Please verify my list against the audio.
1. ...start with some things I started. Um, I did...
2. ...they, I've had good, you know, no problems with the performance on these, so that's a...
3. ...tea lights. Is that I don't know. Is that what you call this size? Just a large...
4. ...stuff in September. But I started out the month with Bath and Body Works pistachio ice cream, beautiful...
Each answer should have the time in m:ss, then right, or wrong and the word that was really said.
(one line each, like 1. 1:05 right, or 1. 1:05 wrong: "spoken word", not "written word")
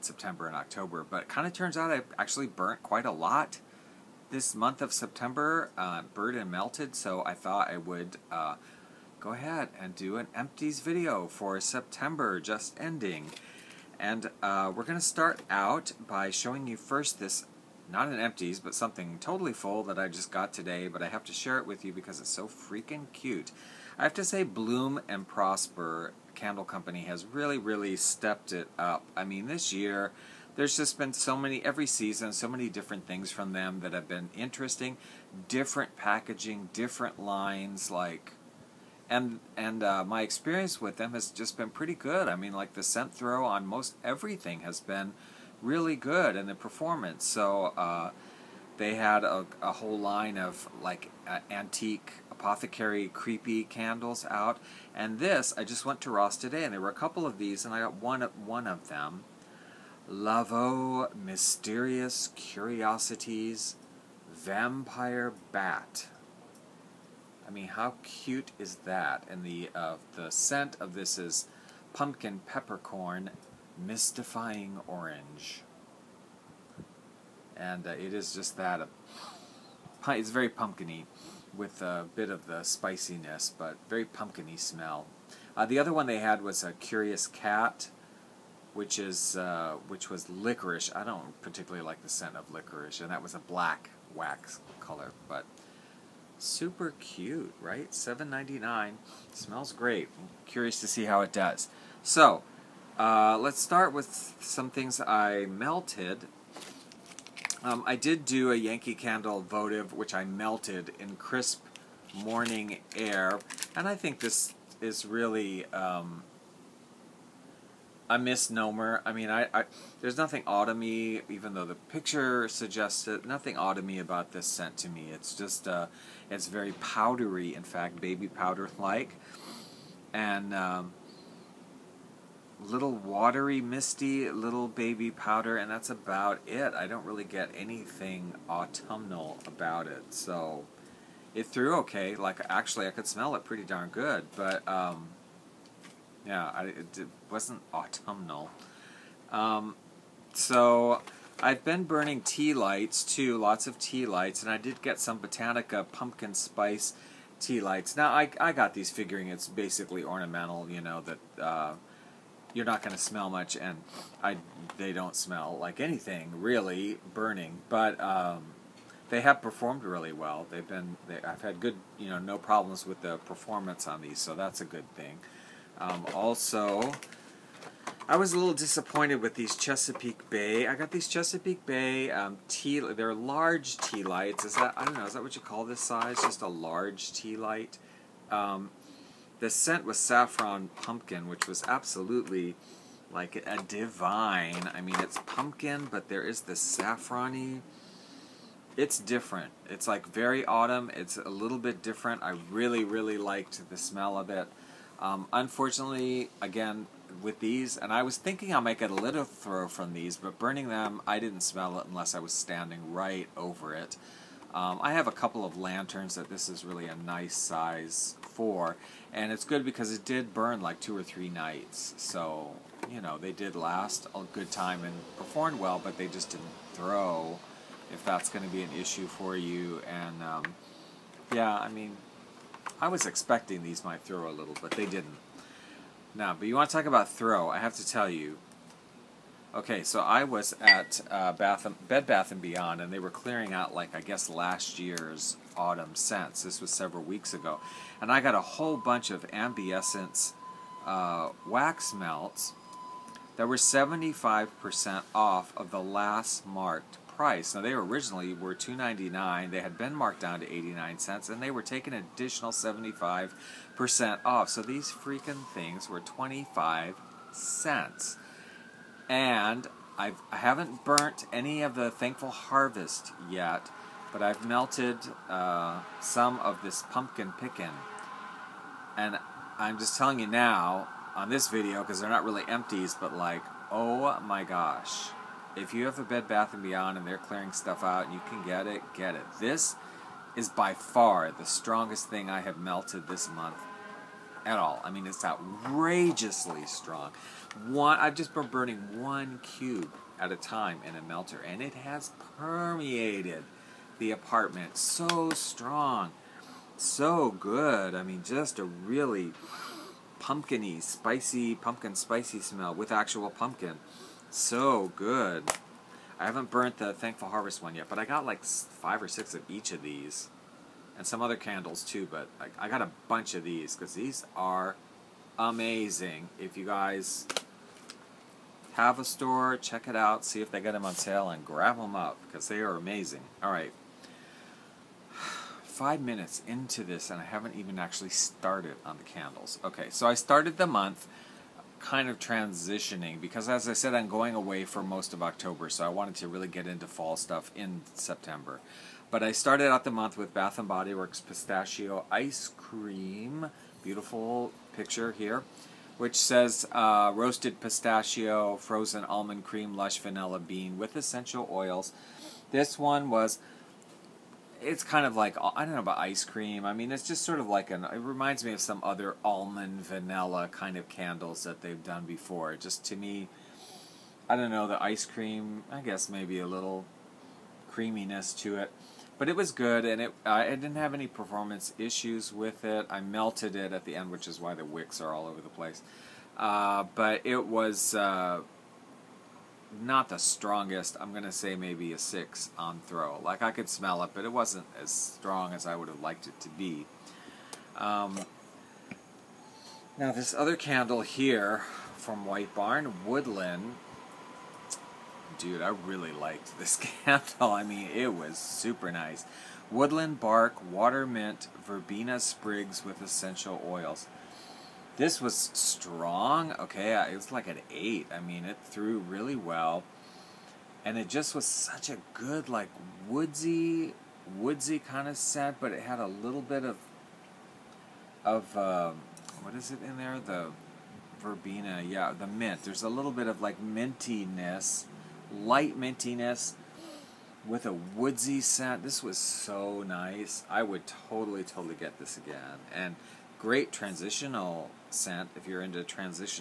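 1. 1:43 wrong: "melted", not "started"
2. 2:51 right
3. 3:03 right
4. 5:47 right.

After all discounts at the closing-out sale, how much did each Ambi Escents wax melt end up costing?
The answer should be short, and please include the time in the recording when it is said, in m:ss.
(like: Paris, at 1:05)
25 cents, at 4:26.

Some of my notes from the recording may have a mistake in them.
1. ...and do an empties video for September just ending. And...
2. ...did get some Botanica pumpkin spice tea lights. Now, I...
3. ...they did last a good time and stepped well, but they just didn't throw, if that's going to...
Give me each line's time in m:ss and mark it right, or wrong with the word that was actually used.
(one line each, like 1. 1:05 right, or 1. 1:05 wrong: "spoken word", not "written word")
1. 0:09 right
2. 2:34 right
3. 3:43 wrong: "performed", not "stepped".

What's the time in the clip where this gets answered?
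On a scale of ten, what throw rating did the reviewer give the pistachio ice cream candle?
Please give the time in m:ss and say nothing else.
6:31.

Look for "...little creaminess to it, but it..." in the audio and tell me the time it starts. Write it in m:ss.
6:16.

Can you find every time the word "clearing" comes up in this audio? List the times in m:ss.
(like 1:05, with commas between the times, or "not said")
4:03, 4:47.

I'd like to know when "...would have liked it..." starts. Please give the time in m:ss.
6:35.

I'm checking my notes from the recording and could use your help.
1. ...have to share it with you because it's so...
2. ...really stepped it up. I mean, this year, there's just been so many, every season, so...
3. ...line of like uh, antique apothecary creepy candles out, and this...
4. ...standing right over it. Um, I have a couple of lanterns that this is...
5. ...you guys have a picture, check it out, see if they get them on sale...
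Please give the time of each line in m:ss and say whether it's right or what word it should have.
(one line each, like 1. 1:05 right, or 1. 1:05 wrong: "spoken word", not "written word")
1. 0:21 right
2. 0:27 right
3. 0:49 right
4. 3:32 right
5. 5:26 wrong: "store", not "picture".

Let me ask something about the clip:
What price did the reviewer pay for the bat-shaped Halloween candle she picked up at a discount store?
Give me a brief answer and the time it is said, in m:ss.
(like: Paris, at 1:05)
$7.99, at 1:37.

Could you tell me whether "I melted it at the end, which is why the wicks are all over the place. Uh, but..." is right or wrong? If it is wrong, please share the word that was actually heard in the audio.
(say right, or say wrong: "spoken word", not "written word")
right.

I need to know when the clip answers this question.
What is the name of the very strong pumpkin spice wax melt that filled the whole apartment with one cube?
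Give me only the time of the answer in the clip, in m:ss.
4:36.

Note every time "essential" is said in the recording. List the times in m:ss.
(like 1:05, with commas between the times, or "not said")
6:00, 6:53.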